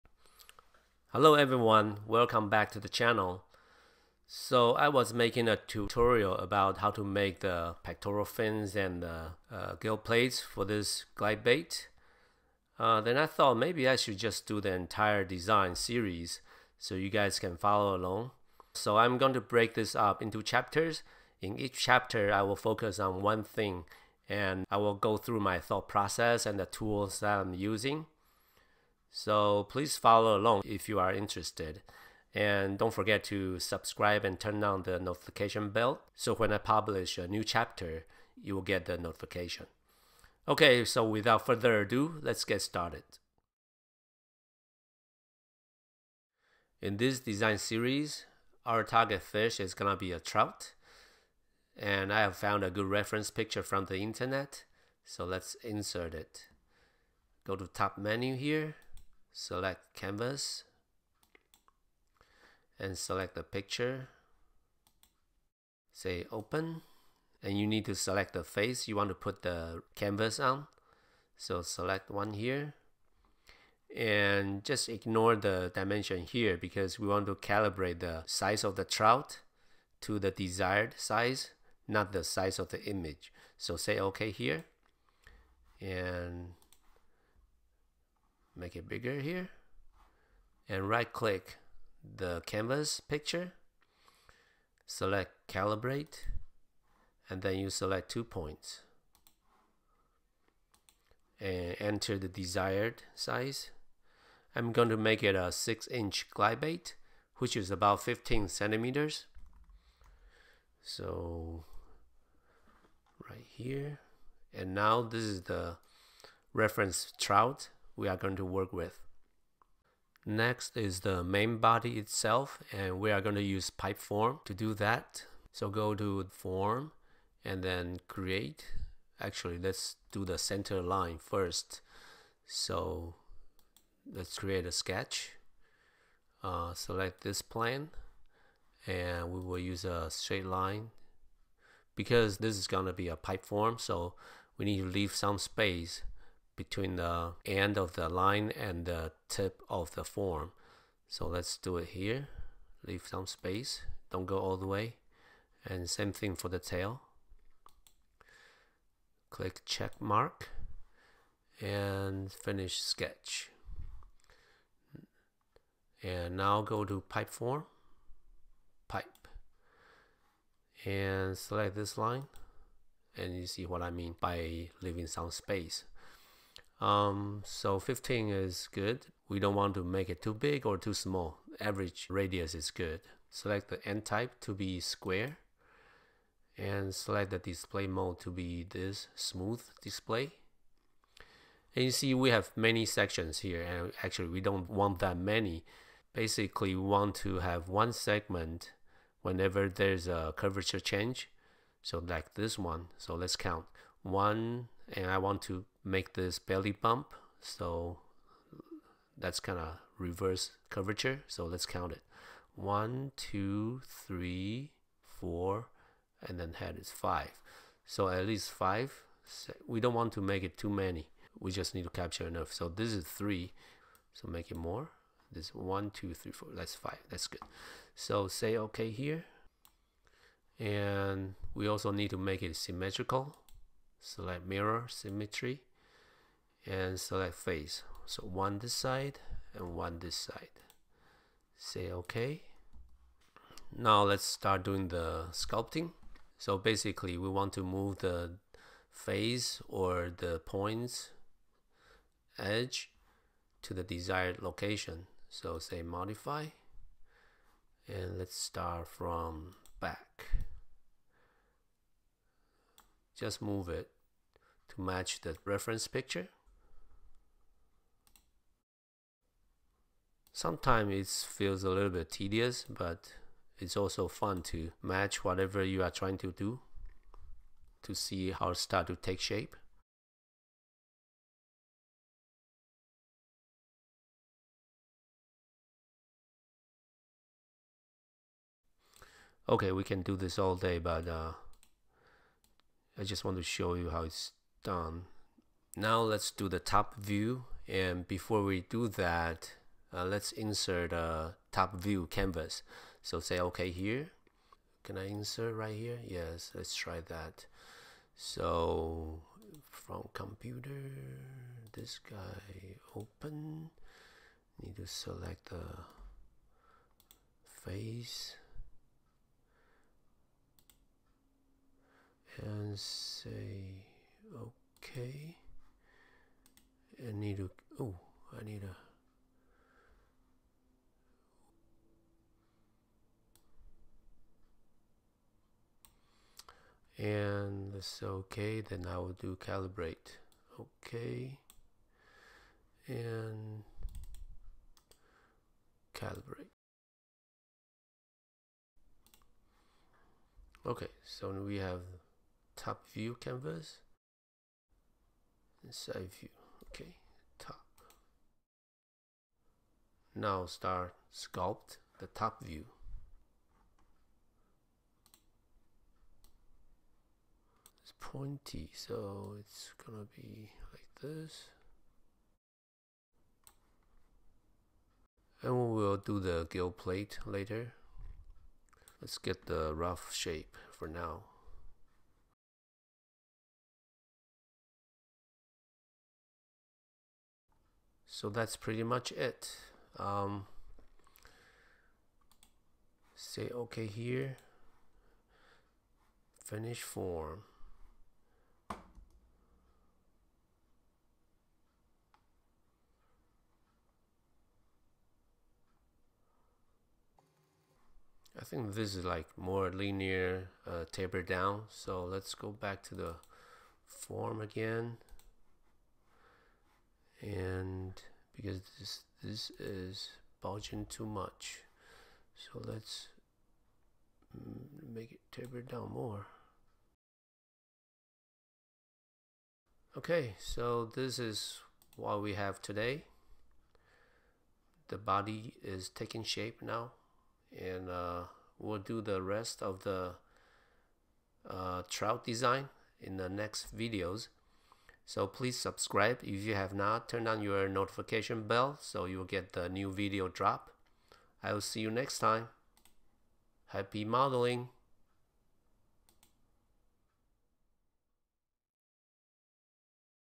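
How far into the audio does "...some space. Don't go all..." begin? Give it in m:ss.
2:33.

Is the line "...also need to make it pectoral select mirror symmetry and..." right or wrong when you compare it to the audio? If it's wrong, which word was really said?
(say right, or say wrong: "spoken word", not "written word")
wrong: "symmetrical", not "pectoral".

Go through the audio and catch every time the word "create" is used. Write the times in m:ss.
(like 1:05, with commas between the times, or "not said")
2:08, 2:14.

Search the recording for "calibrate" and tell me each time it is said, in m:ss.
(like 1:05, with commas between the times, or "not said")
1:17, 1:35, 5:39, 5:45.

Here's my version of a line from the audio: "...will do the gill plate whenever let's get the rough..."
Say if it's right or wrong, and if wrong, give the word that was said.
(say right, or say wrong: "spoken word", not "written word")
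wrong: "later", not "whenever".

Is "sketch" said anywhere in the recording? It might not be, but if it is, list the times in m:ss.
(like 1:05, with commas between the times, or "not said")
2:14, 2:42.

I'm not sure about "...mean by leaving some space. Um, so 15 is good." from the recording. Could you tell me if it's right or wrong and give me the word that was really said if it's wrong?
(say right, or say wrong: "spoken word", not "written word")
right.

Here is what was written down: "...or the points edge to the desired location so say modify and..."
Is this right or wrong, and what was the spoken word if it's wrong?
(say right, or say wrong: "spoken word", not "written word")
right.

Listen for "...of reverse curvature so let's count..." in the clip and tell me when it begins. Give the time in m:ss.
3:29.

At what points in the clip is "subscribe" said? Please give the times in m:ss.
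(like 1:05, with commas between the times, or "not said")
0:33, 7:25.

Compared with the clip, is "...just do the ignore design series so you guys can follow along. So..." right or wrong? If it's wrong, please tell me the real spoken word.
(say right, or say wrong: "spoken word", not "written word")
wrong: "entire", not "ignore".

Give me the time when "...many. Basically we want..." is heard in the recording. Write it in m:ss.
3:15.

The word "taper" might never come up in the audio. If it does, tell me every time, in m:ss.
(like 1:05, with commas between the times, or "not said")
6:50, 7:05.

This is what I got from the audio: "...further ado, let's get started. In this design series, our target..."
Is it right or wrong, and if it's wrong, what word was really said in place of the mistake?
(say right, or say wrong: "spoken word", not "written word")
right.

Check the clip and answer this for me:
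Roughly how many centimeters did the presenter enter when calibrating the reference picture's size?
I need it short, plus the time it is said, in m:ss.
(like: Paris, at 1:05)
15, at 1:48.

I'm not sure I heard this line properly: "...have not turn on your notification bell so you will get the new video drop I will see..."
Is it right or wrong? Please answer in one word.
right.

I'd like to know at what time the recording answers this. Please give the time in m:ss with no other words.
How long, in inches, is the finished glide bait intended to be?
1:45.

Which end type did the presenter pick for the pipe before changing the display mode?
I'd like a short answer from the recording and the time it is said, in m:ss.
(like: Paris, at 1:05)
Square, at 3:04.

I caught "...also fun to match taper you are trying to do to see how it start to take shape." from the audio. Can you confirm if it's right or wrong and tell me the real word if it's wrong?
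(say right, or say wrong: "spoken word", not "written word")
wrong: "whatever", not "taper".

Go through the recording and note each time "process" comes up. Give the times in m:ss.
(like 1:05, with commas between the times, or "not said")
0:25.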